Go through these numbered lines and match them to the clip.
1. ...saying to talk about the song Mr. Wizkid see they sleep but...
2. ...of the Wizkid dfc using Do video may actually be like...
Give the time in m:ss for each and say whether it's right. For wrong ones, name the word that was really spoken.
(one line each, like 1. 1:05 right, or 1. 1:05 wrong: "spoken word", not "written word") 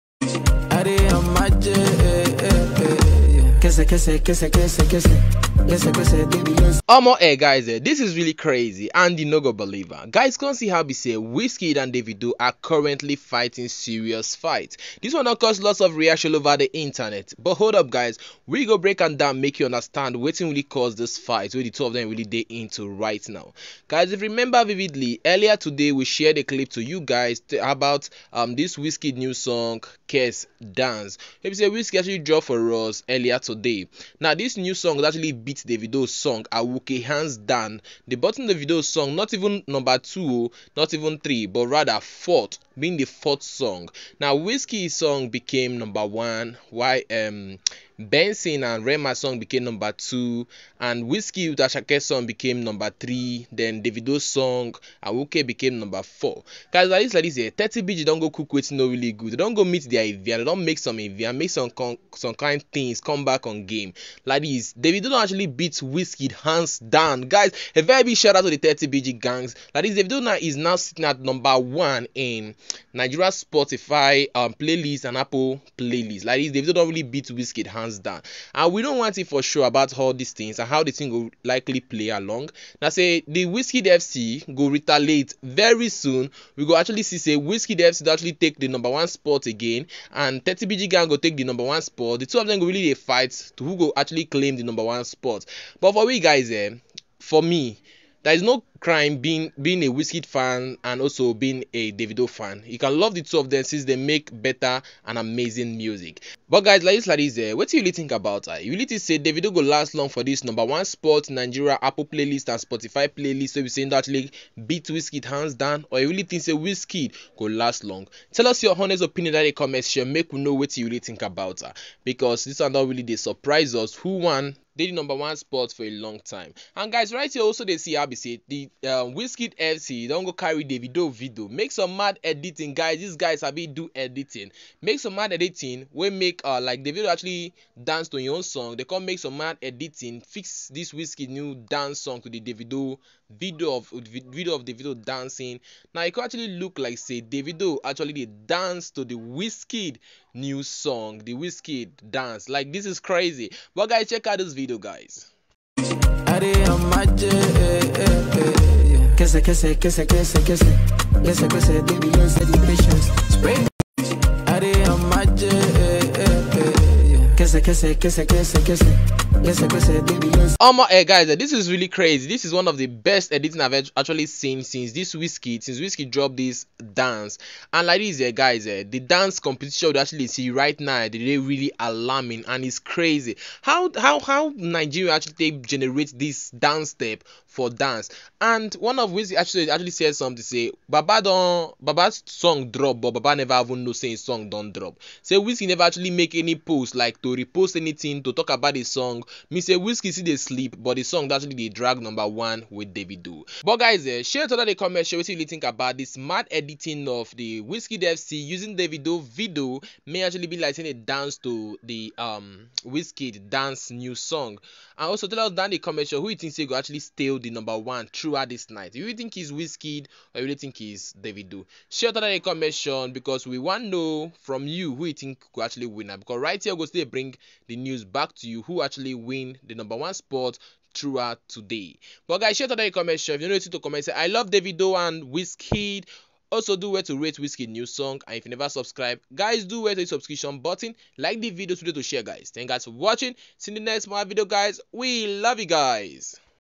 1. 3:17 wrong: "anything", not "saying"
2. 3:27 right.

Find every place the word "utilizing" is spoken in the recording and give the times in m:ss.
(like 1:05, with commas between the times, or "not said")
not said.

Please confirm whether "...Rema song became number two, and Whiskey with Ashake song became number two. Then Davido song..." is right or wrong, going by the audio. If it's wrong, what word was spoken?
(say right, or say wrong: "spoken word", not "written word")
wrong: "three", not "two".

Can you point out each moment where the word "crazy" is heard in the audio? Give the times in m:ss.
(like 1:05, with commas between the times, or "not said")
0:08, 2:32, 2:51, 3:02.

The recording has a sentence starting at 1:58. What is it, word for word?
Tell us your honest opinion in the comments.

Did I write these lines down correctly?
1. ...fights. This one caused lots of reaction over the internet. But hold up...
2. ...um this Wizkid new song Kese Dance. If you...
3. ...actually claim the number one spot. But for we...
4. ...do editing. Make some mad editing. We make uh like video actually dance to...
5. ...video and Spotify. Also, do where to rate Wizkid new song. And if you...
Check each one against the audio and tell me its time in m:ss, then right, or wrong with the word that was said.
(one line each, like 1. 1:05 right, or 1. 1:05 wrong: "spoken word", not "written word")
1. 0:14 right
2. 0:28 right
3. 1:33 right
4. 2:13 right
5. 3:54 wrong: "Wizkid", not "Spotify".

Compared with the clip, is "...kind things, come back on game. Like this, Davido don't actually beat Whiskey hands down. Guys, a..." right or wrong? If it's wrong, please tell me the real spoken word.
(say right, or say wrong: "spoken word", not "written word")
right.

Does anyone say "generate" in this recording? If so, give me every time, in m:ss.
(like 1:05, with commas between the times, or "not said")
3:05.